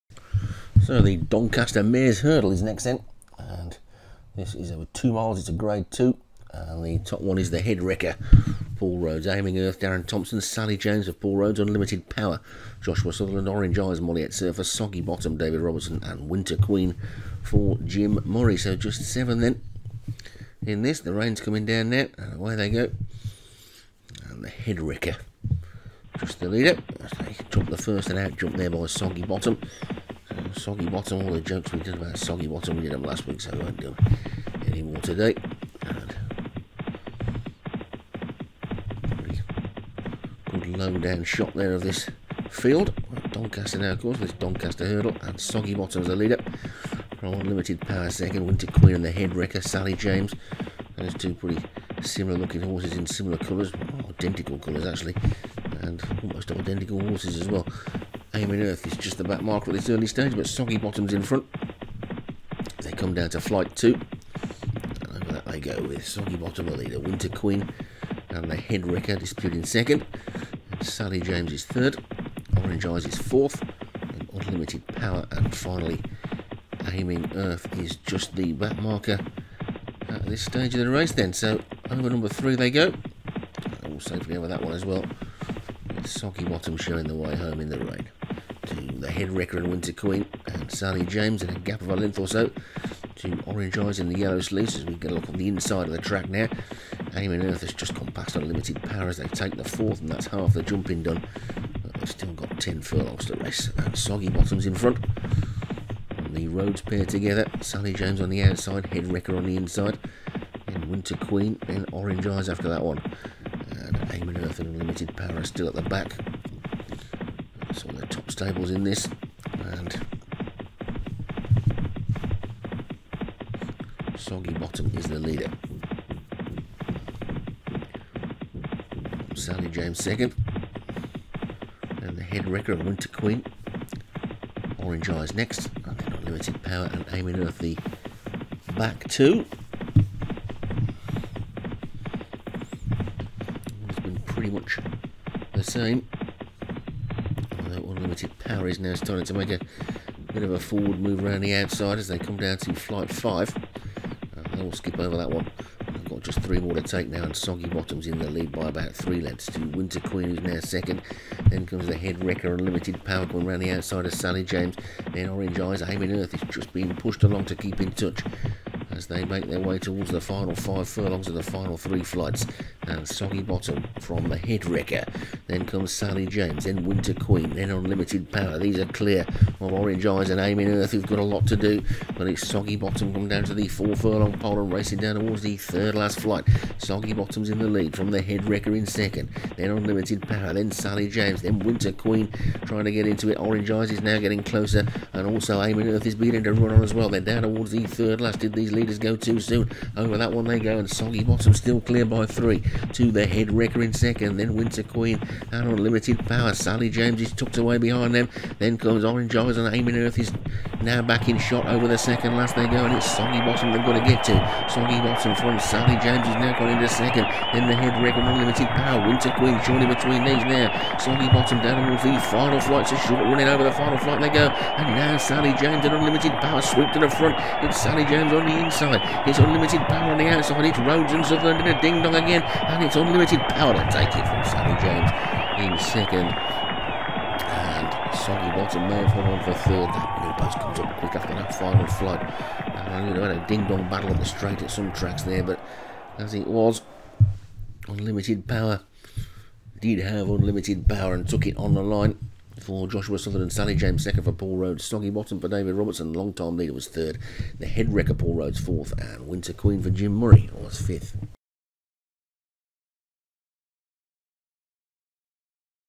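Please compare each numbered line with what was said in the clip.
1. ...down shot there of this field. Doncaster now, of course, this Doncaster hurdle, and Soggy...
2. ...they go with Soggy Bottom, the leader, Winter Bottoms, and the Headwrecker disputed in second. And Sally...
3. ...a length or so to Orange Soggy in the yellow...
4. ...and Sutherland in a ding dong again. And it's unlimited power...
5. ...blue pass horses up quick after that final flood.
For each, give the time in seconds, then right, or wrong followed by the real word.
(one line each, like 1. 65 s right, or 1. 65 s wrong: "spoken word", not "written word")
1. 40 s right
2. 65 s wrong: "Queen", not "Bottoms"
3. 91 s wrong: "Eyes", not "Soggy"
4. 231 s right
5. 240 s wrong: "comes", not "horses".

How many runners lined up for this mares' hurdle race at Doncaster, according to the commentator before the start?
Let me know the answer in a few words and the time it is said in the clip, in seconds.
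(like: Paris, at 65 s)
7, at 19 s.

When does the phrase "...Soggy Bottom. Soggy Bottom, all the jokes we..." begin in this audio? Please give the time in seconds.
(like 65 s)
28 s.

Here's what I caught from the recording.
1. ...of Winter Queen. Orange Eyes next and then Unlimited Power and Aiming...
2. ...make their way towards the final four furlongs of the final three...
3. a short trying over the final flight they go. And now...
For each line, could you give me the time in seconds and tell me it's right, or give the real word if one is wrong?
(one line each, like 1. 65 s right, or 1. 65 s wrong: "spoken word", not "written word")
1. 132 s right
2. 169 s wrong: "five", not "four"
3. 222 s wrong: "running", not "trying".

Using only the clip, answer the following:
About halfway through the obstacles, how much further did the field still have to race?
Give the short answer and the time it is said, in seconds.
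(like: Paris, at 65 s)
10 furlongs, at 102 s.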